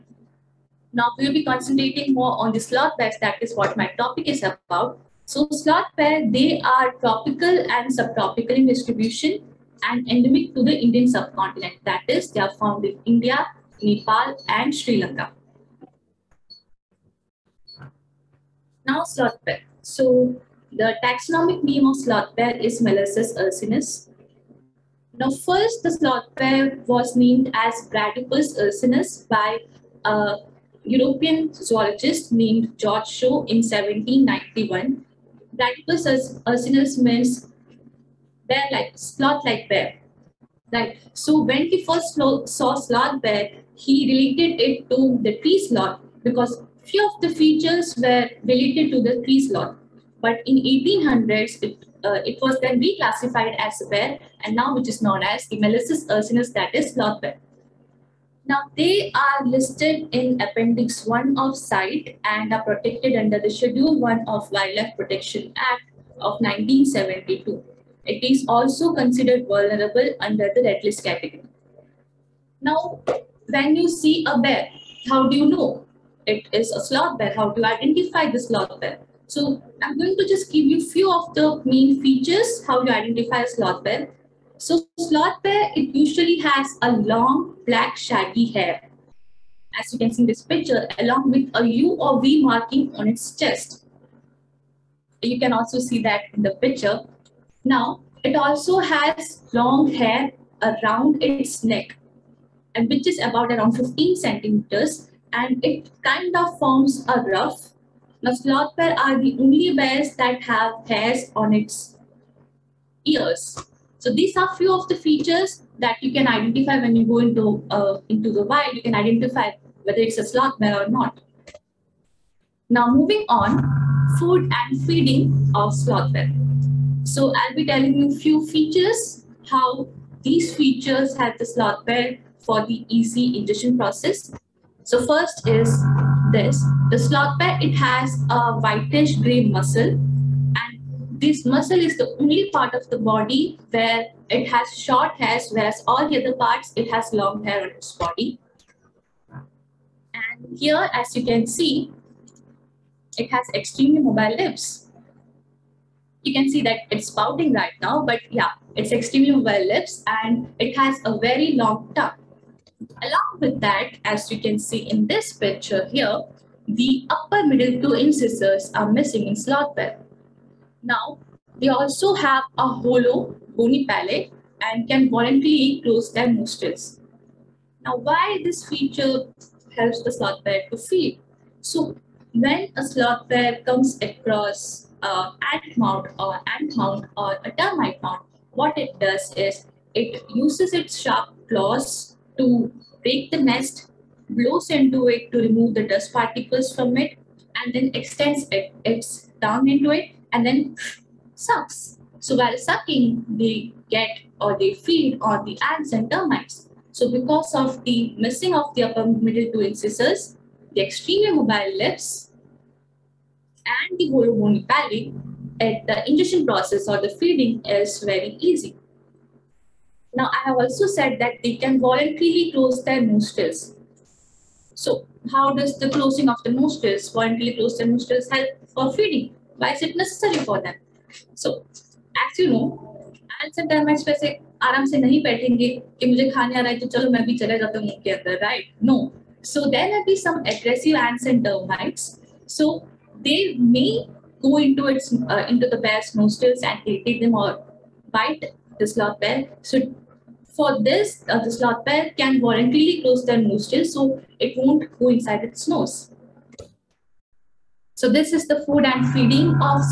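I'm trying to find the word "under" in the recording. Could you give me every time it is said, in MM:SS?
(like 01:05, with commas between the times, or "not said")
01:03, 01:10.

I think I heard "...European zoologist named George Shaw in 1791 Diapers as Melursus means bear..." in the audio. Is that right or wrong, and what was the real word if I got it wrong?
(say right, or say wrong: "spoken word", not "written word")
wrong: "Ursinus", not "Melursus".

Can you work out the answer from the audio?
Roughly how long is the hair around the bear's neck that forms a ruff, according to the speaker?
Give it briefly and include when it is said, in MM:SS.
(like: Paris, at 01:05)
15 centimeters, at 01:43.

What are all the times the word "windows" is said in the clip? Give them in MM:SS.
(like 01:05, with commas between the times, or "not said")
not said.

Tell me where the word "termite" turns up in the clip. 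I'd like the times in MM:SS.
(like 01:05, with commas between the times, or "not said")
03:07, 03:26.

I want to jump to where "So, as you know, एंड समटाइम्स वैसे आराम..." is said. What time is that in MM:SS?
03:51.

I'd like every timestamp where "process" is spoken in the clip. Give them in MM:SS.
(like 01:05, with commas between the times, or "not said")
02:13, 03:36.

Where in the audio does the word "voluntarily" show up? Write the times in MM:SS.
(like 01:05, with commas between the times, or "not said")
02:55, 03:41, 03:47, 04:12.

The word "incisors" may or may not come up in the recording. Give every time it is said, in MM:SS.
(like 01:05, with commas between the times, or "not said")
02:47, 03:29.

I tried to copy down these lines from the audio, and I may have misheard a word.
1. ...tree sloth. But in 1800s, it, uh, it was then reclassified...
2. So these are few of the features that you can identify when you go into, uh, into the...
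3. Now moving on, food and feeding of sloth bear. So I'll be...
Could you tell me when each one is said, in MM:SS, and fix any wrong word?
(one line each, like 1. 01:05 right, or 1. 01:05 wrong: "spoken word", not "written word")
1. 00:49 right
2. 01:54 right
3. 02:02 right.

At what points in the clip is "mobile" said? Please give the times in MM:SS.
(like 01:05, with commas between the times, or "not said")
02:34, 02:39, 03:31.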